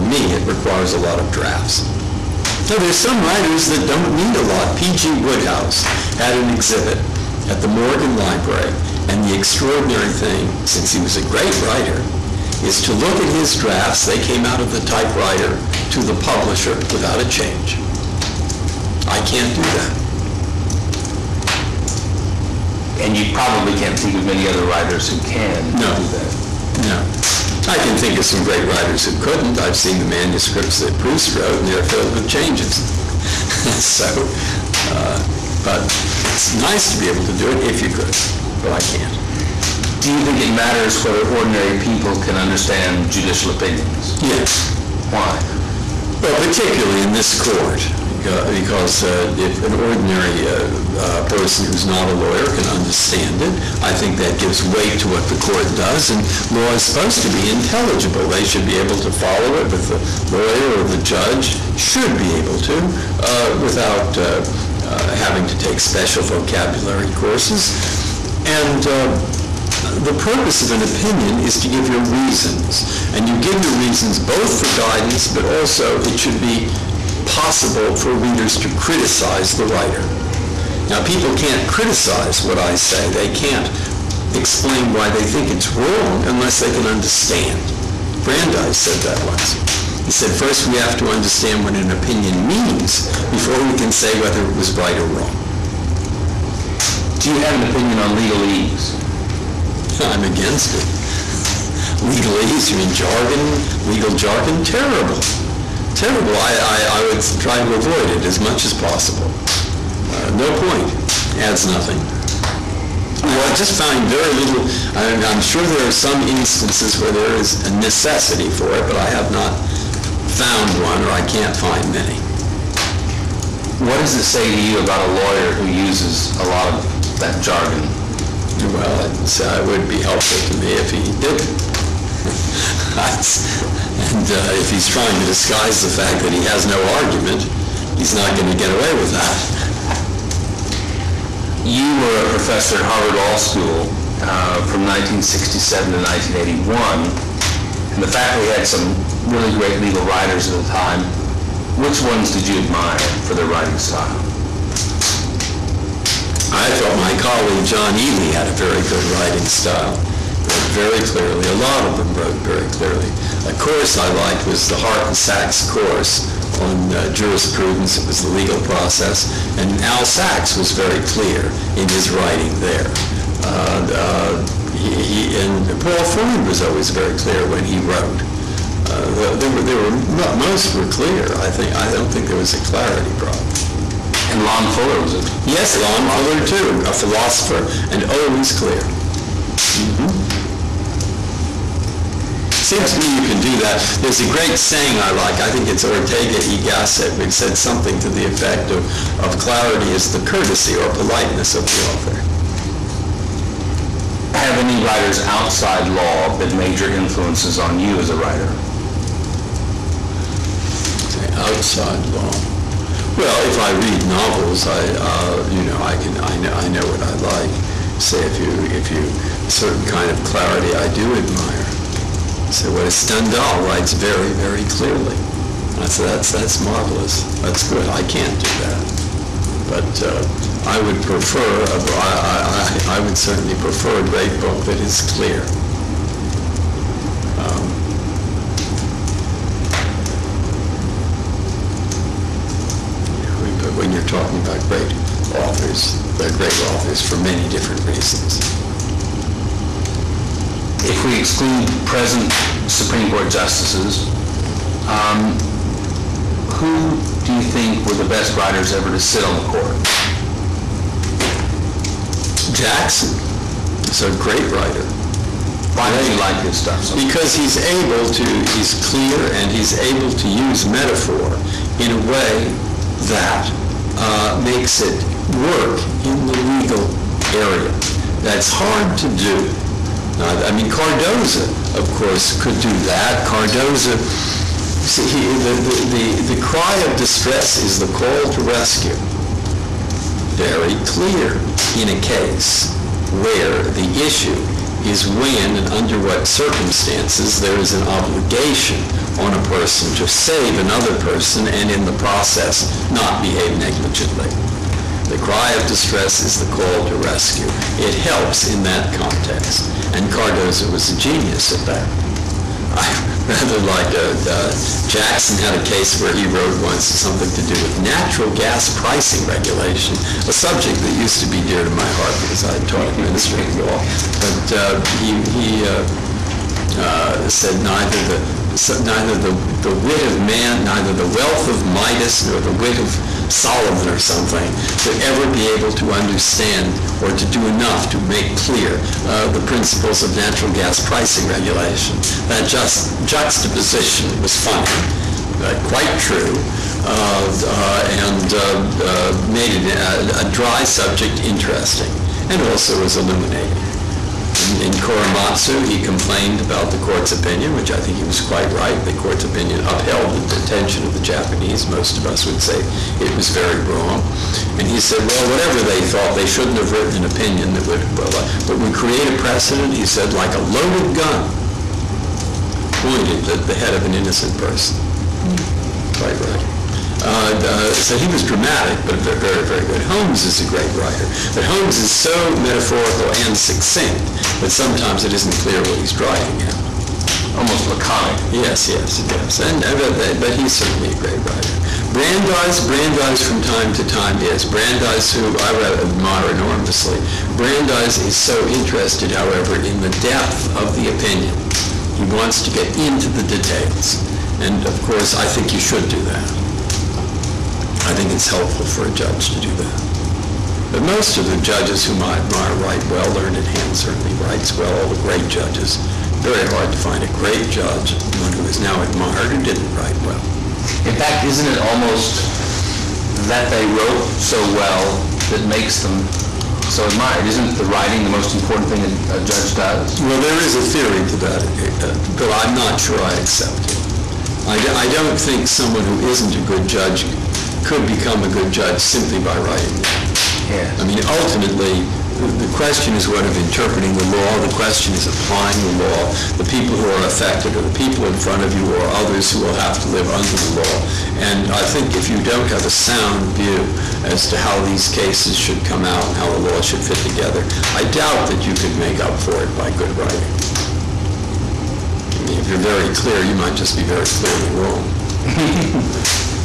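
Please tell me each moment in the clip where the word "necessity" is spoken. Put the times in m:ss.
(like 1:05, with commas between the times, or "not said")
1:57.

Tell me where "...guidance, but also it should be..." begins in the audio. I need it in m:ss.
1:14.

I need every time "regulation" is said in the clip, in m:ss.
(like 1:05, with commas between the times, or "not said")
5:19, 5:41.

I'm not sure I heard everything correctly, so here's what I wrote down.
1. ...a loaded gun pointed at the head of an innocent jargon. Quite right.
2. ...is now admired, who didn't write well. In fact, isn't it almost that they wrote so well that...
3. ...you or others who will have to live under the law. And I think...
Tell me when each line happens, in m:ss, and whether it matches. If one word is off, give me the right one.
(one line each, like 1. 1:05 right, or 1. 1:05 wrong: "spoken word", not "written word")
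1. 6:10 wrong: "person", not "jargon"
2. 6:58 right
3. 7:28 right.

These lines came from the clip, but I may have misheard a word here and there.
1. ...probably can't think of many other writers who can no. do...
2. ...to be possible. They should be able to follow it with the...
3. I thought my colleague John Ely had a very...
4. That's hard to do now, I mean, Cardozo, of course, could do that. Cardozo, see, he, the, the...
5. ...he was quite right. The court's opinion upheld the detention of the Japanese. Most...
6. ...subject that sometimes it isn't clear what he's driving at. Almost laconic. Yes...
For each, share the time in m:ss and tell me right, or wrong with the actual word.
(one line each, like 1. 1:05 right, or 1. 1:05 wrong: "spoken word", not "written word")
1. 0:23 right
2. 0:57 wrong: "intelligible", not "possible"
3. 2:36 right
4. 4:38 right
5. 5:57 right
6. 6:23 wrong: "succinct", not "subject".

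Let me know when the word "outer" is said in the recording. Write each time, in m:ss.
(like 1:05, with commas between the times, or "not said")
not said.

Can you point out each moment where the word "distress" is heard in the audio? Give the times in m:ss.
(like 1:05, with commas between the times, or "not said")
4:46, 5:05.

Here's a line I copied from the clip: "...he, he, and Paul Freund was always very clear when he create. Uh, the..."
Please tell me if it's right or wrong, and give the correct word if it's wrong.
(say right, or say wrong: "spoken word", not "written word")
wrong: "wrote", not "create".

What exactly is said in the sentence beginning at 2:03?
What does it say to you about a lawyer who uses a lot of that jargon?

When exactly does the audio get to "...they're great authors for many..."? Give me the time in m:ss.
4:06.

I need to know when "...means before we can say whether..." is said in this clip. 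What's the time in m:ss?
1:32.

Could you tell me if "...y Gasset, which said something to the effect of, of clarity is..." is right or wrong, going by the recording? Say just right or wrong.
right.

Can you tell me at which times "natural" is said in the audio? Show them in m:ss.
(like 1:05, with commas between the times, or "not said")
5:17, 5:40.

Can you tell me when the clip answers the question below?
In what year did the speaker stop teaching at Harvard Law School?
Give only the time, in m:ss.
2:26.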